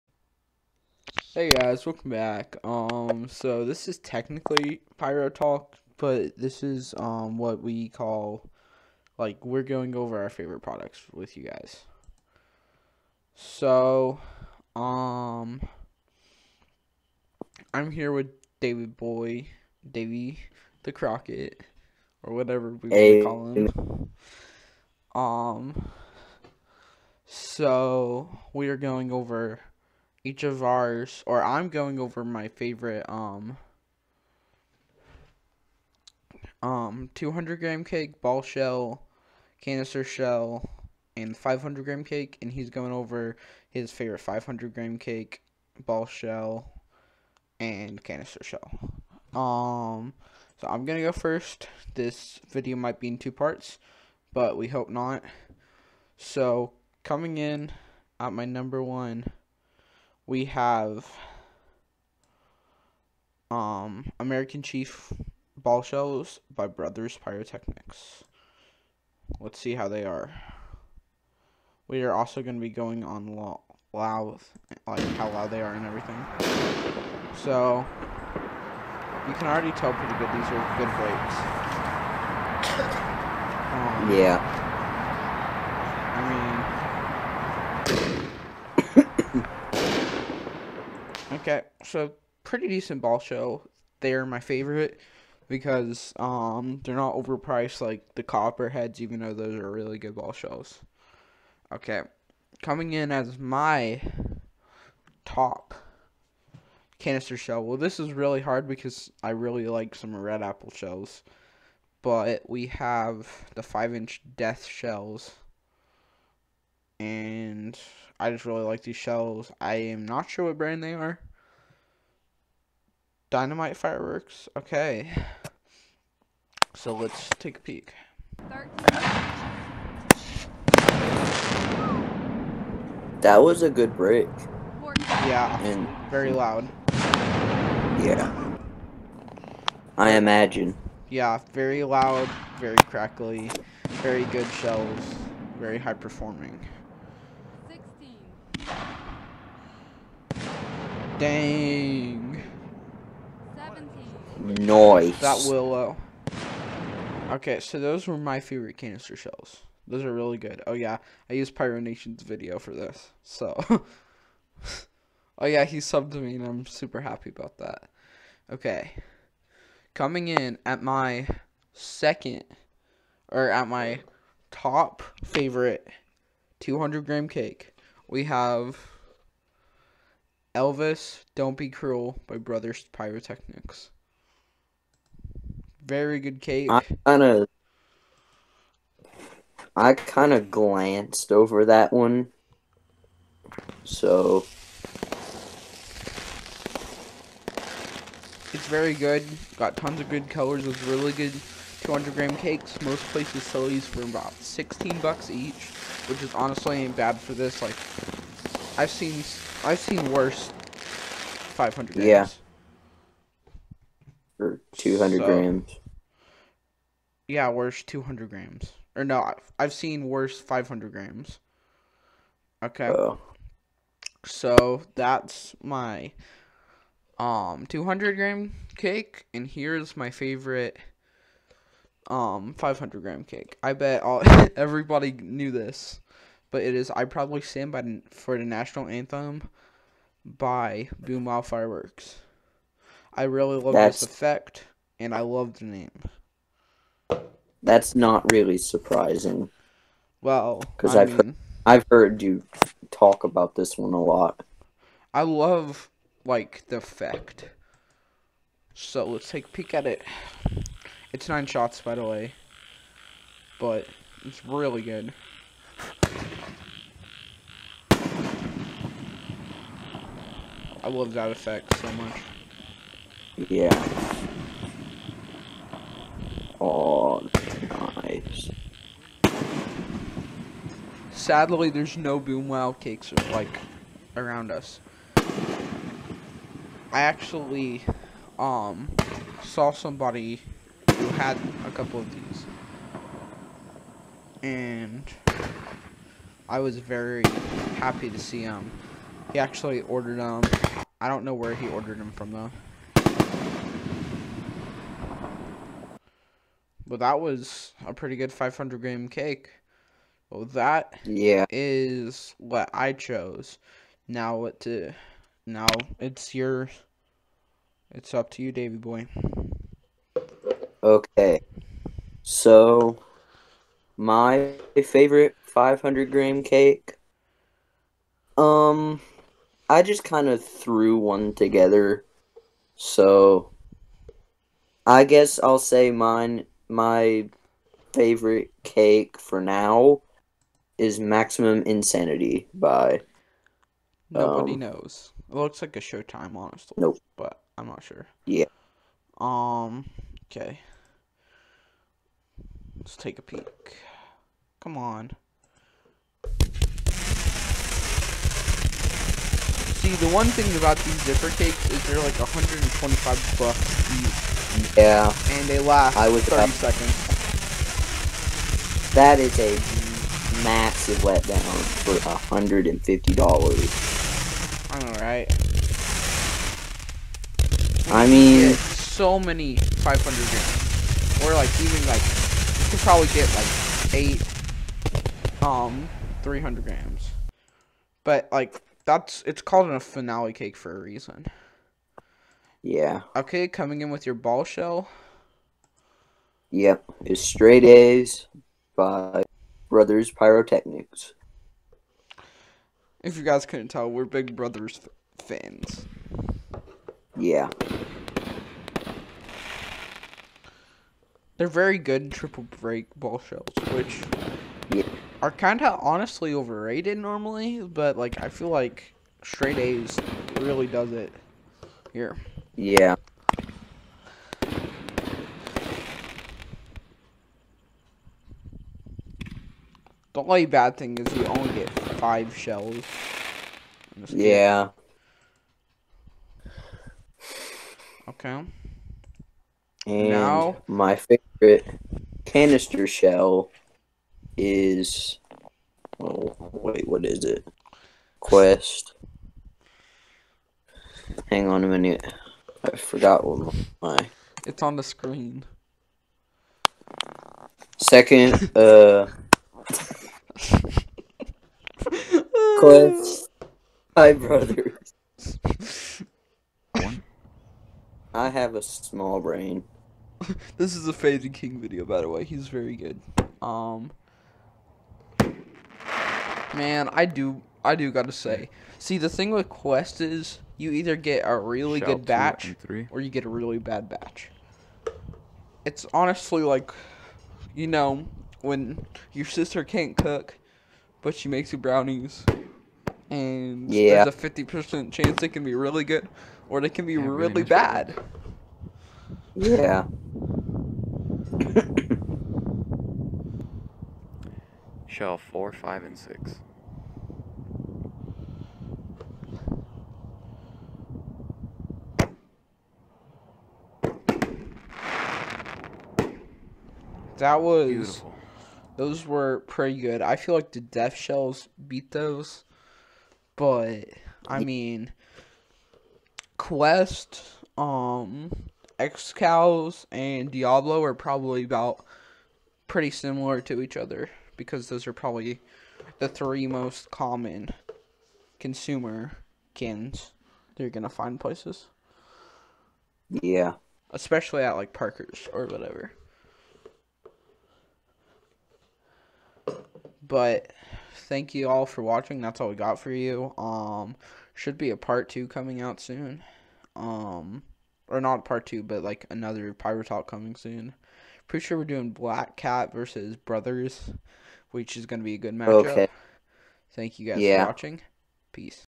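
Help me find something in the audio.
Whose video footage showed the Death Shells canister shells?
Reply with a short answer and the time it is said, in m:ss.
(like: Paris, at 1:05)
Pyronation, at 2:41.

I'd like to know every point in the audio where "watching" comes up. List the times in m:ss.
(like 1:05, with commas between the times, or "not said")
9:11, 9:27.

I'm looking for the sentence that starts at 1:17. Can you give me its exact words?
So, you can already tell pretty good these are good breaks.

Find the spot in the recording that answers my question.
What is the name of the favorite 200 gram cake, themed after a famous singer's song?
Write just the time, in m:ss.
3:00.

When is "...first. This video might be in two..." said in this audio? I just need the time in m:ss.
0:51.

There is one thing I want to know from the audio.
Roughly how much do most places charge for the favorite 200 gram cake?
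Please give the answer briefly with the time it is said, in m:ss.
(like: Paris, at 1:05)
$16, at 3:24.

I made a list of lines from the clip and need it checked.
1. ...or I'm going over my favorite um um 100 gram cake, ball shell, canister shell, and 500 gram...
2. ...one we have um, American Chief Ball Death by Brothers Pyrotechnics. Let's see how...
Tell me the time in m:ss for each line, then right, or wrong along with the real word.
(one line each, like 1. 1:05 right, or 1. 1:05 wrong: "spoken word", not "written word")
1. 0:31 wrong: "200", not "100"
2. 0:58 wrong: "Shells", not "Death".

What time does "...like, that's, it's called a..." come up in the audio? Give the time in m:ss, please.
6:28.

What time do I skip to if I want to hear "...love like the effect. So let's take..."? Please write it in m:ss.
4:15.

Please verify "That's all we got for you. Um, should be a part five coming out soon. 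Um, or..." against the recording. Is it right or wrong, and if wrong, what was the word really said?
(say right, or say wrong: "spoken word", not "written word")
wrong: "two", not "five".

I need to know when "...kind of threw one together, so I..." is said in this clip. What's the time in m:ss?
5:30.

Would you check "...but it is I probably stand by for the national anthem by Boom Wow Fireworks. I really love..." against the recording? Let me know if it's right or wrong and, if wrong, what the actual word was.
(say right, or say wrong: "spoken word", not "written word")
right.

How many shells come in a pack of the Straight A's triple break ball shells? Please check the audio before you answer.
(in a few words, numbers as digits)
5.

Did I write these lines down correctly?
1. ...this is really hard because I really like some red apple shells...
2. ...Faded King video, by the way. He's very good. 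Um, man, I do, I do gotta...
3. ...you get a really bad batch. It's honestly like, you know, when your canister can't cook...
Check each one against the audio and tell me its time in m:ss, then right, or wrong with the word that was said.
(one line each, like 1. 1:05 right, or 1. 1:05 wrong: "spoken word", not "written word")
1. 1:47 right
2. 7:50 right
3. 8:03 wrong: "sister", not "canister".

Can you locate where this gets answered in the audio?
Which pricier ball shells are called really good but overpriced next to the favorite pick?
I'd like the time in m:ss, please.
1:38.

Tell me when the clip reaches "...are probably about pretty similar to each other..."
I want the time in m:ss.
8:50.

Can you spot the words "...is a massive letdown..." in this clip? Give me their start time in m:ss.
6:09.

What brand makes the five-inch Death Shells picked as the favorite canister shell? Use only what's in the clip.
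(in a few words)
Dynamite fireworks.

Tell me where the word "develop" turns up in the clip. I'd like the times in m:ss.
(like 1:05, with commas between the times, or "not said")
not said.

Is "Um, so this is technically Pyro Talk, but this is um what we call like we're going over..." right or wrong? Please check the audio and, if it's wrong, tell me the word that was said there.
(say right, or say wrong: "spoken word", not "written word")
right.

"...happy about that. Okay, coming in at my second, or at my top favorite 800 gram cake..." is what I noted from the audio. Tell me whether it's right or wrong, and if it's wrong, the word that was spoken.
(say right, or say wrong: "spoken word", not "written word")
wrong: "200", not "800".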